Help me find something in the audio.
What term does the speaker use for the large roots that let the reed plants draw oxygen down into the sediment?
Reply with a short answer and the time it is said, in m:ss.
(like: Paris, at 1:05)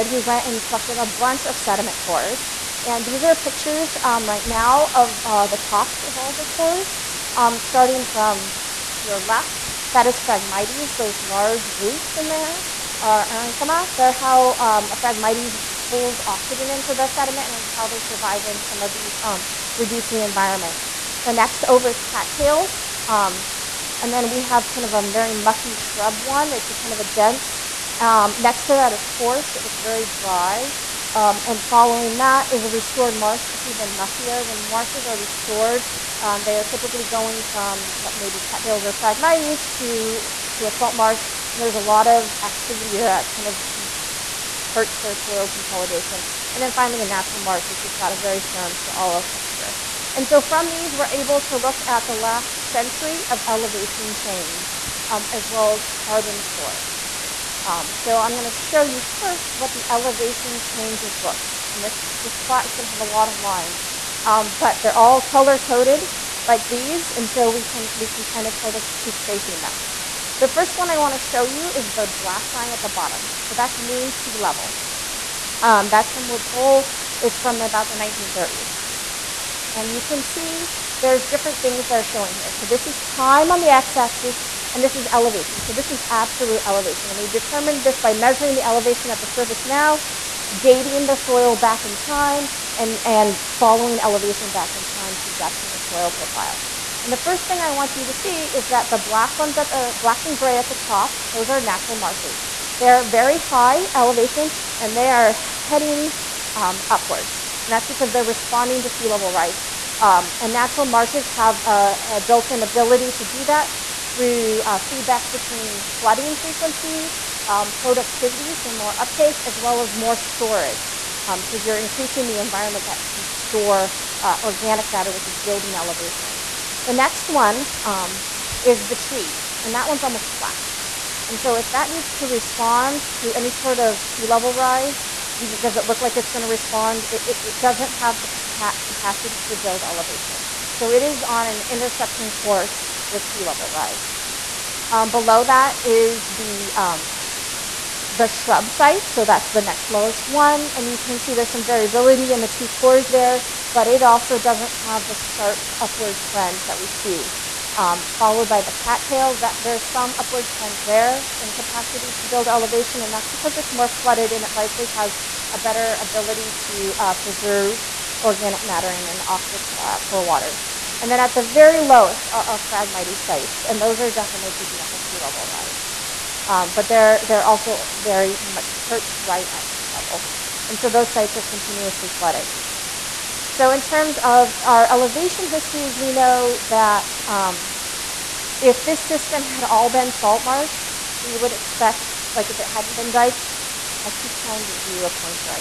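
parenchyma, at 0:13.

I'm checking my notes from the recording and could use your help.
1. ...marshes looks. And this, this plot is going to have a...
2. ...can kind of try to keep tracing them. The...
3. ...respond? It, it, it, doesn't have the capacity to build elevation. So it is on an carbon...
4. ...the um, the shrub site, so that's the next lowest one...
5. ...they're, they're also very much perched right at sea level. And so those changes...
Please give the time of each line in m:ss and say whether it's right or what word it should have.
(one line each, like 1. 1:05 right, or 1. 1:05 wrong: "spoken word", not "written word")
1. 1:00 wrong: "changes", not "marshes"
2. 1:08 right
3. 2:16 wrong: "interception", not "carbon"
4. 2:26 right
5. 2:56 wrong: "sites", not "changes".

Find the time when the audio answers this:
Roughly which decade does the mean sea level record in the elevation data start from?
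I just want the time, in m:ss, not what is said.
1:17.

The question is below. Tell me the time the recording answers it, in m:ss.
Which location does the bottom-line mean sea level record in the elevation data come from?
1:16.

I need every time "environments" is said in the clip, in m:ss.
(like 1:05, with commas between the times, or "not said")
0:20, 2:02.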